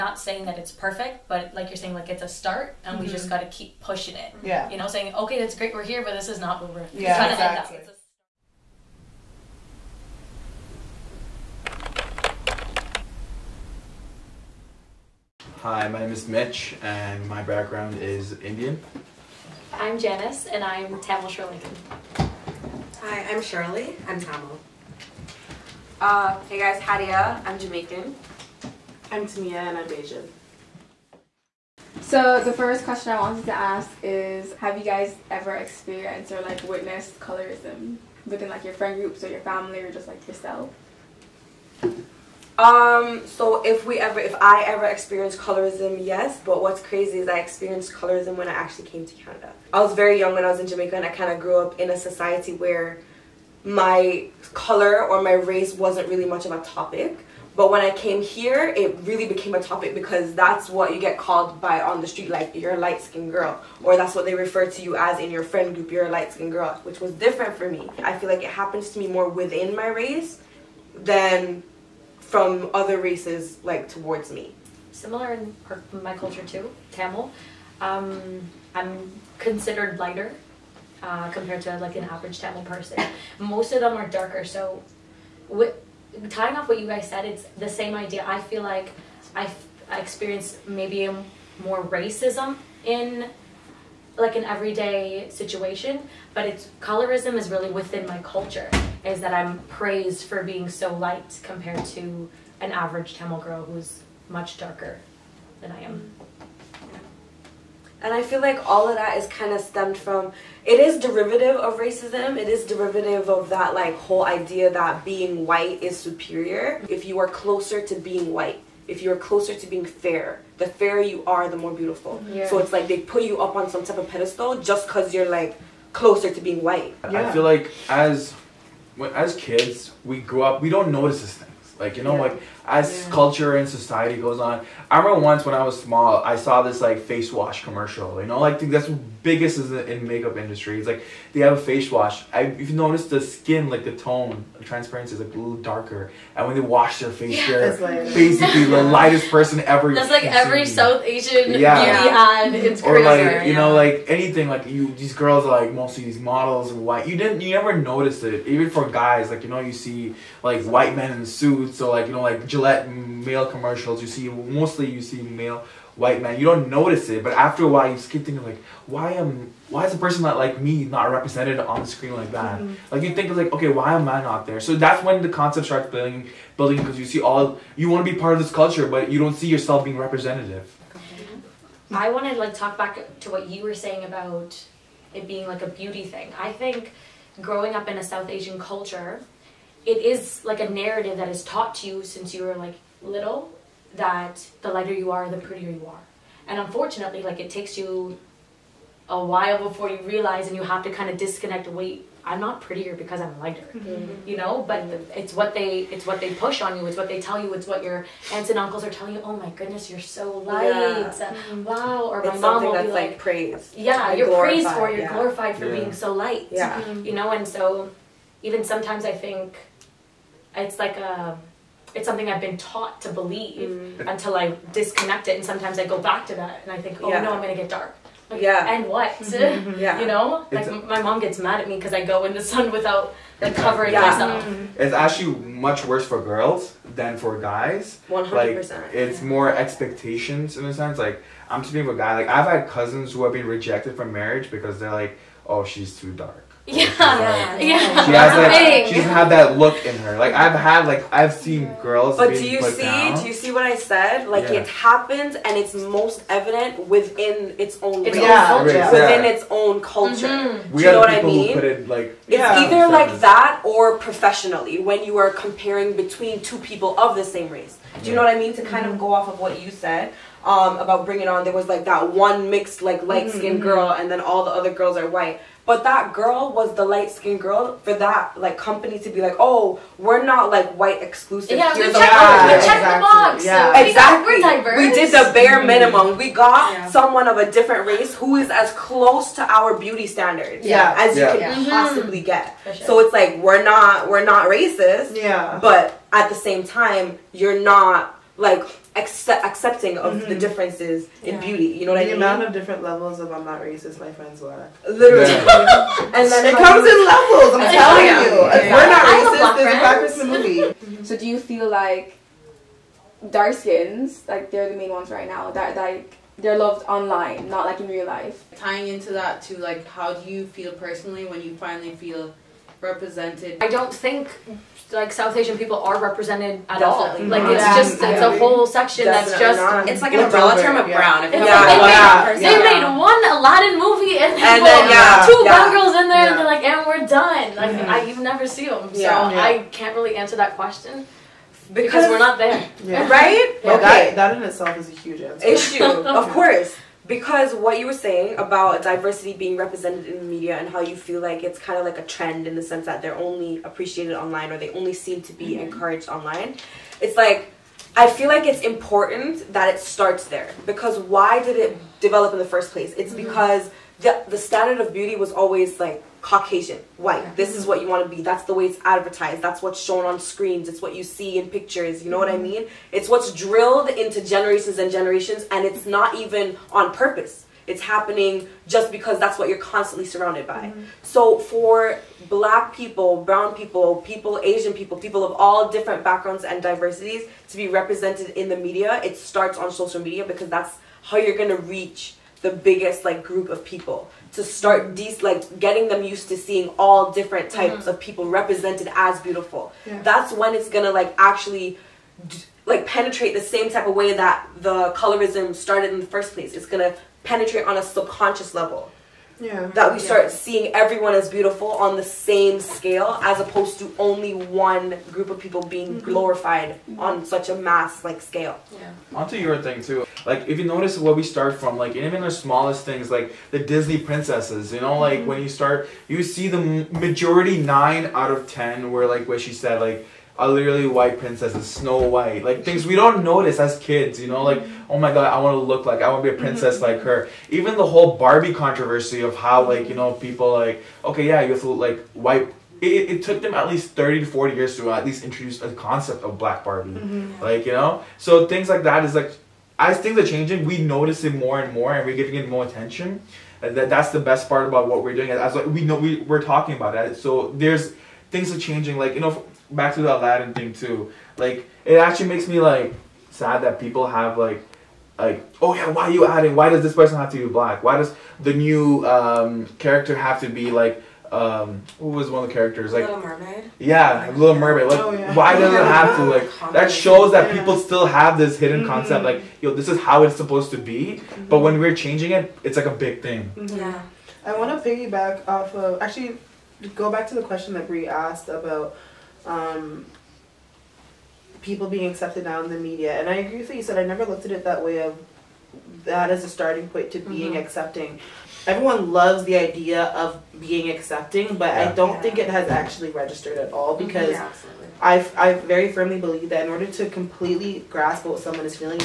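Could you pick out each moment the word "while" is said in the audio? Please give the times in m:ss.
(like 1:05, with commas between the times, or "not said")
2:47, 3:19.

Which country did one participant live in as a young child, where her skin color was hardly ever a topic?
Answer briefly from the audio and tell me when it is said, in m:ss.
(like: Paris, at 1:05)
Jamaica, at 0:49.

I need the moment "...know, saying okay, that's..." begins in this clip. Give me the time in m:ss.
0:04.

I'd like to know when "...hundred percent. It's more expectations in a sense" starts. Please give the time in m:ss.
3:58.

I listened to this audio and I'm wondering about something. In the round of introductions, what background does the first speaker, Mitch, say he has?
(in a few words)
Indian.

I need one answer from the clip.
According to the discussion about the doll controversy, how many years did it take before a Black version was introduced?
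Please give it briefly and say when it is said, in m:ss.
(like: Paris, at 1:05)
30 to 40 years, at 7:23.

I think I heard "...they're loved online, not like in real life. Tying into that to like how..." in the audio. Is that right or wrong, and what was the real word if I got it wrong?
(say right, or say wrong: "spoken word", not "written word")
right.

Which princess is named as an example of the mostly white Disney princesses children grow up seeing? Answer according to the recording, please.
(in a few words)
Snow White.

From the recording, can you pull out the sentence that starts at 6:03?
because the, the standard of beauty was always like Caucasian, white.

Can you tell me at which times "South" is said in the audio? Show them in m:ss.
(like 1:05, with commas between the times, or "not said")
2:30, 3:08, 5:25.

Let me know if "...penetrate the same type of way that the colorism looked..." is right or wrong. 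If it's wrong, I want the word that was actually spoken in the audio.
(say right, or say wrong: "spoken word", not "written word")
wrong: "started", not "looked".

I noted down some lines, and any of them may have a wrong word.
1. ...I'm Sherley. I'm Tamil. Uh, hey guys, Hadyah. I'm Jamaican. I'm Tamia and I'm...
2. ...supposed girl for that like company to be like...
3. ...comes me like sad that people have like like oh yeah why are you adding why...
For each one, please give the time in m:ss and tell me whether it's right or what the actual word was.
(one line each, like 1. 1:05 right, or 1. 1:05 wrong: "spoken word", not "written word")
1. 0:23 right
2. 4:37 wrong: "skinned", not "supposed"
3. 7:42 wrong: "makes", not "comes".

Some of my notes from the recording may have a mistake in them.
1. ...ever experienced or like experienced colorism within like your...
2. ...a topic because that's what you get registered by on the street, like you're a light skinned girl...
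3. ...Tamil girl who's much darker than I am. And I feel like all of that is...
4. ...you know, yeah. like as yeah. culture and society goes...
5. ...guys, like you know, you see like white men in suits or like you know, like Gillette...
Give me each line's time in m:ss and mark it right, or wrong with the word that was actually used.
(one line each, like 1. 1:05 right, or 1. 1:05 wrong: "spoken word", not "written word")
1. 0:35 wrong: "witnessed", not "experienced"
2. 0:59 wrong: "called", not "registered"
3. 1:43 right
4. 2:11 right
5. 2:38 right.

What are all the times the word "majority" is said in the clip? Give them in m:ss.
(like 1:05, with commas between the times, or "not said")
7:07.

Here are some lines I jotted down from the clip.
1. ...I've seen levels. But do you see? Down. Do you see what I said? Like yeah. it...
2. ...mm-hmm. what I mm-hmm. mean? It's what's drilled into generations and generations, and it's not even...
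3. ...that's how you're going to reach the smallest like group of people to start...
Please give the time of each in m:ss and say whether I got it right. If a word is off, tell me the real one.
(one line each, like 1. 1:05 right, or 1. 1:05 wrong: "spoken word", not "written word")
1. 4:11 wrong: "girls", not "levels"
2. 6:12 right
3. 6:30 wrong: "biggest", not "smallest".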